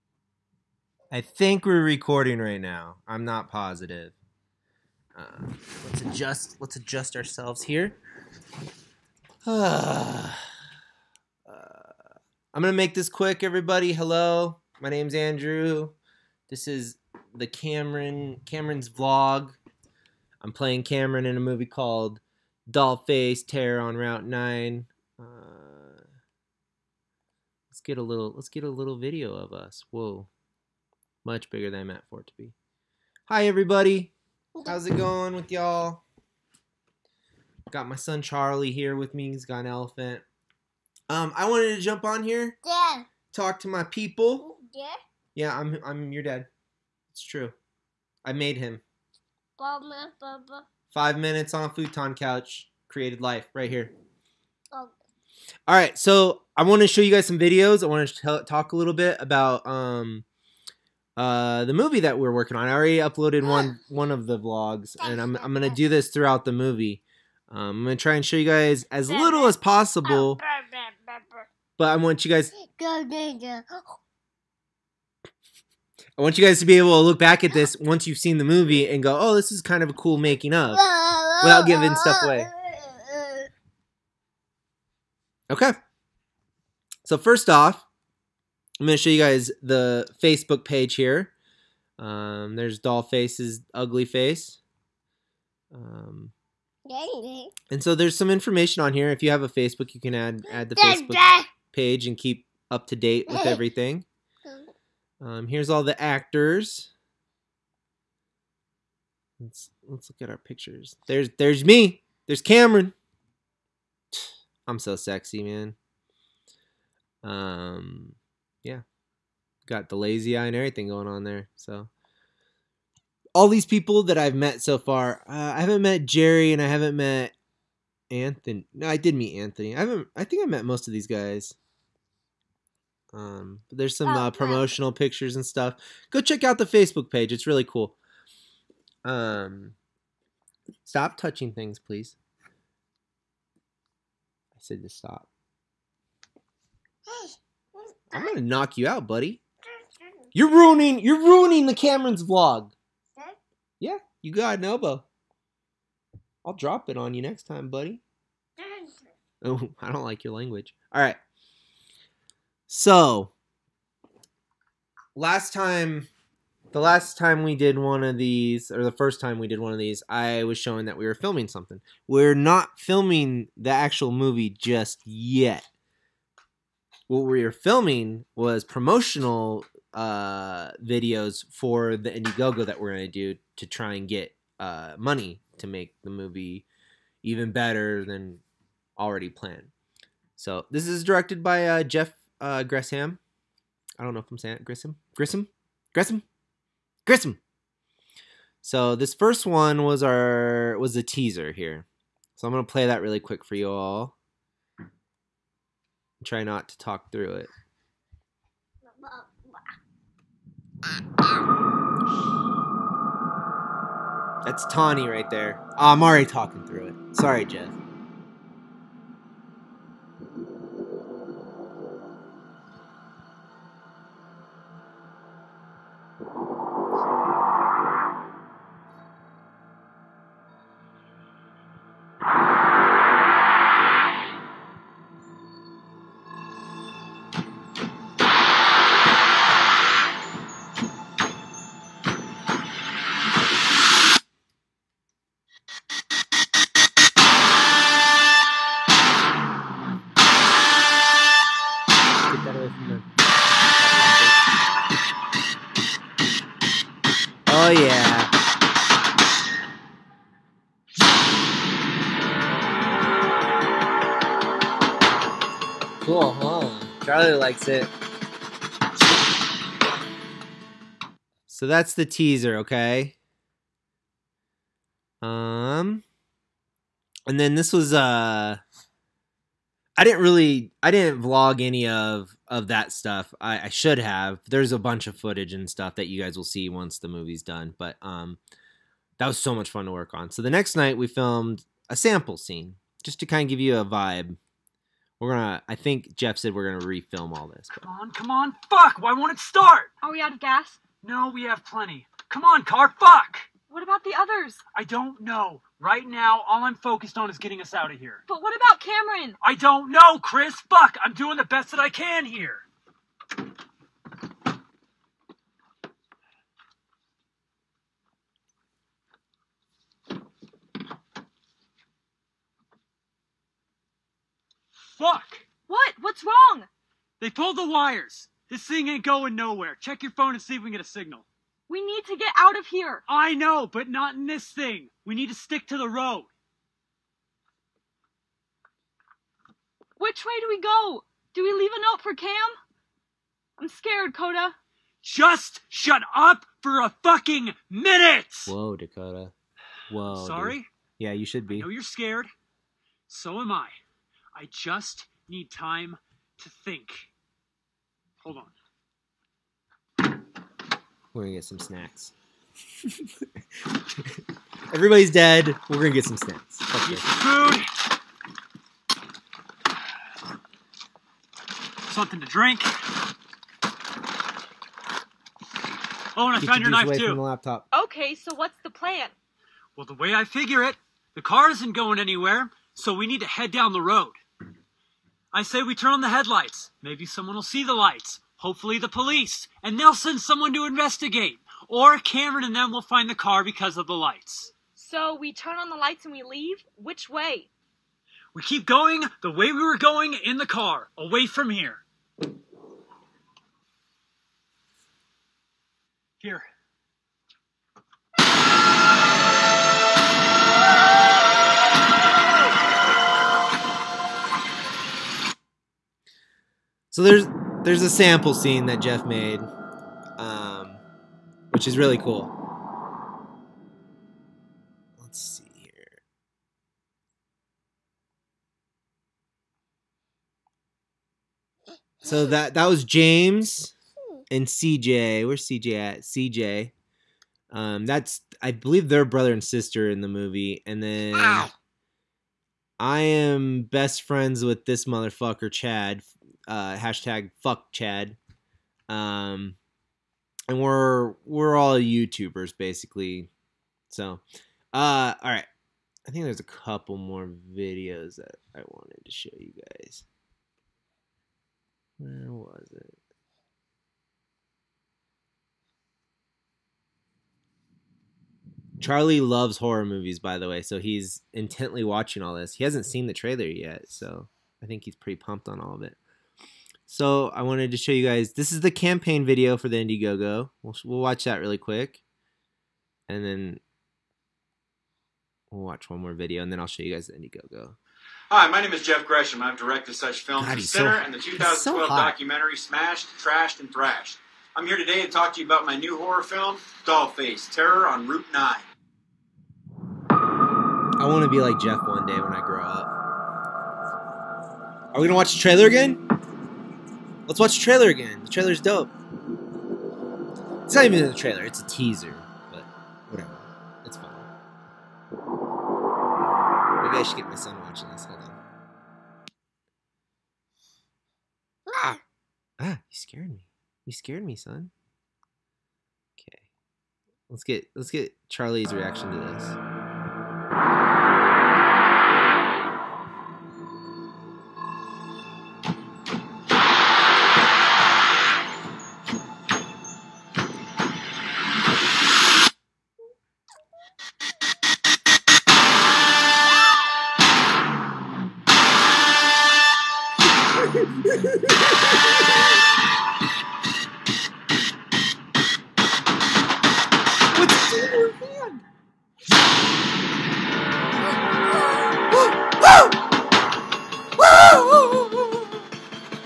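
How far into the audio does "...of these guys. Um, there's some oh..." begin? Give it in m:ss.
2:10.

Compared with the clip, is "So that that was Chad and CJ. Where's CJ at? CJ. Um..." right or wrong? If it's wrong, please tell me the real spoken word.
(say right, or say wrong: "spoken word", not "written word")
wrong: "James", not "Chad".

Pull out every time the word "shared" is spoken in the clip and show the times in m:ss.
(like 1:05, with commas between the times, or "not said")
not said.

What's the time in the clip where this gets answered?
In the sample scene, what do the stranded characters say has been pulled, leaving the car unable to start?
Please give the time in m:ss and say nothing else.
5:27.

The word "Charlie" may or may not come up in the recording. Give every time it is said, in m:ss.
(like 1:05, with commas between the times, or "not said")
0:38, 7:48, 8:48.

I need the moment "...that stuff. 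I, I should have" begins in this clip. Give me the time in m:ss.
4:42.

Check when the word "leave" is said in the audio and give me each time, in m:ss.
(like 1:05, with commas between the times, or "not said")
5:41, 6:36.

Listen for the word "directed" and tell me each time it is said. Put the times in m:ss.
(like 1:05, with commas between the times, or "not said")
3:11, 8:09.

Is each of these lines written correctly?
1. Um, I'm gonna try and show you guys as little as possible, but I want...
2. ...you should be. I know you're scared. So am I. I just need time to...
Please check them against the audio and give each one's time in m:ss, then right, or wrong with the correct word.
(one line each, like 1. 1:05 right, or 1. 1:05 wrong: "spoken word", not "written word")
1. 1:07 right
2. 5:51 right.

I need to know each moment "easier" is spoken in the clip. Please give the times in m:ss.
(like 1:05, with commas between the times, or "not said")
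not said.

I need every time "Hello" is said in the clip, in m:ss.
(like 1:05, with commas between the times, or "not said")
0:13.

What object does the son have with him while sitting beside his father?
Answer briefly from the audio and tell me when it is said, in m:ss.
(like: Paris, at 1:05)
An elephant, at 0:39.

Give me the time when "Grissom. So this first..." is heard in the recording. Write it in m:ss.
3:17.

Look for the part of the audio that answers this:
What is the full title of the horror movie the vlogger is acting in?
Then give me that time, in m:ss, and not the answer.
0:22.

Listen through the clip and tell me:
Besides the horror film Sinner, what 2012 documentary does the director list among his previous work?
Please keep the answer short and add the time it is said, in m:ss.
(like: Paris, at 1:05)
Smashed, Trashed, and Thrashed, at 8:12.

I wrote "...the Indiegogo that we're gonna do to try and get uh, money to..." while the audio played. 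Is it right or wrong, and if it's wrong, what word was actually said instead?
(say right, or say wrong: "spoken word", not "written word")
right.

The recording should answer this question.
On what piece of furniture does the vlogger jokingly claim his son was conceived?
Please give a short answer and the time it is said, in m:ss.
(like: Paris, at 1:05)
Futon couch, at 0:51.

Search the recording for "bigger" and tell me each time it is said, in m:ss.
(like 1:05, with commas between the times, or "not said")
0:31.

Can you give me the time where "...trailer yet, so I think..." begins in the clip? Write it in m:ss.
7:53.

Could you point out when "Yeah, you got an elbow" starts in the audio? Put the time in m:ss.
2:33.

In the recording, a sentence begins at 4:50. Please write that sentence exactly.
So the next night we filmed a sample scene just to kind of give you a vibe we're gonna.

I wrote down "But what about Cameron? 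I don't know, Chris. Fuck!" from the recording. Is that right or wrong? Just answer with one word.
right.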